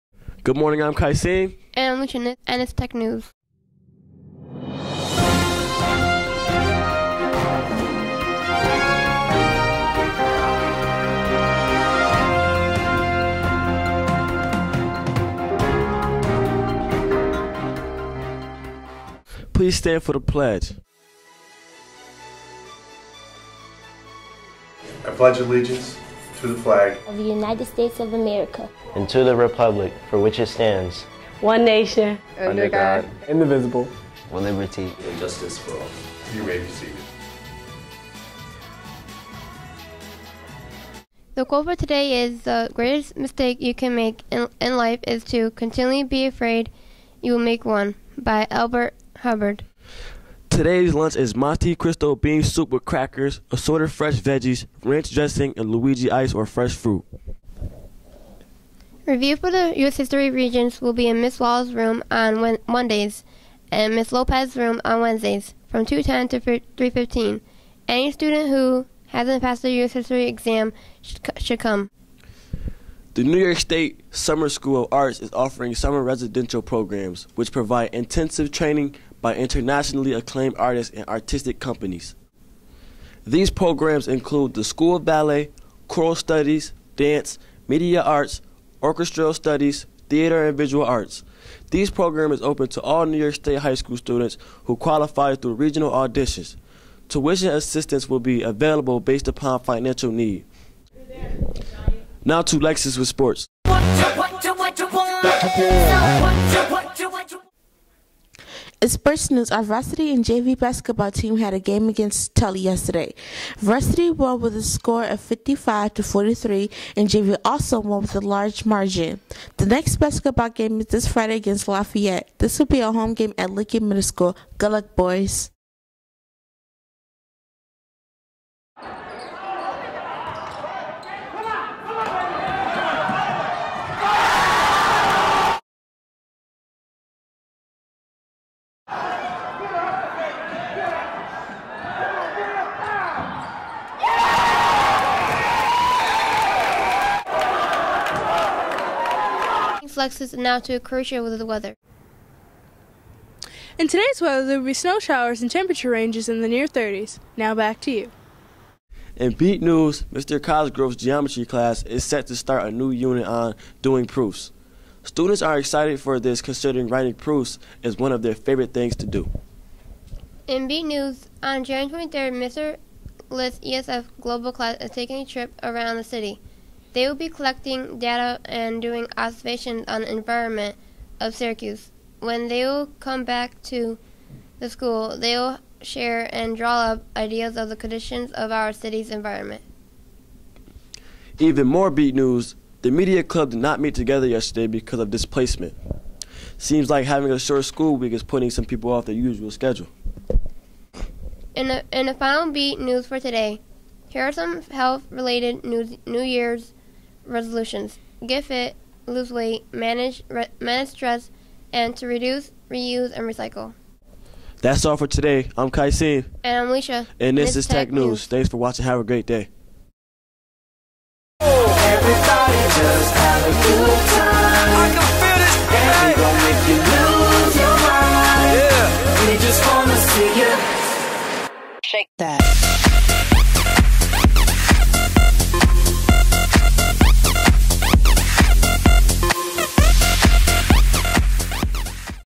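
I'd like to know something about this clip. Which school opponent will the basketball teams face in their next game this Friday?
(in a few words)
Lafayette.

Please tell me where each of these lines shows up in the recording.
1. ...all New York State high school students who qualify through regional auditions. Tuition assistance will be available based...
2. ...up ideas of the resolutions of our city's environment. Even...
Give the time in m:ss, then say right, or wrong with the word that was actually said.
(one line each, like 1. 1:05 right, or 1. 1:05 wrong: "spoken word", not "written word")
1. 1:32 right
2. 3:06 wrong: "conditions", not "resolutions".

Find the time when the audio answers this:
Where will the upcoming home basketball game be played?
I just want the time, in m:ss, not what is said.
2:03.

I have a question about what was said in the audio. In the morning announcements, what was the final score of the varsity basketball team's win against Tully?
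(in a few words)
55 to 43.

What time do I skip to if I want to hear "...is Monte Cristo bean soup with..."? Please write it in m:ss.
0:51.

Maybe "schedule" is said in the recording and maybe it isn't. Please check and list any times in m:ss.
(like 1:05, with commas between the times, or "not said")
3:19.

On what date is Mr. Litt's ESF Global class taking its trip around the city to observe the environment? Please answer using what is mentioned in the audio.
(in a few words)
January 23.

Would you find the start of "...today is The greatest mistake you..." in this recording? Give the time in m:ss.
0:41.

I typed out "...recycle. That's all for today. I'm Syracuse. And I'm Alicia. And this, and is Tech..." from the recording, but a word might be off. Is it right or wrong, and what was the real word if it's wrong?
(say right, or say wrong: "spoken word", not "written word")
wrong: "Kaisim", not "Syracuse".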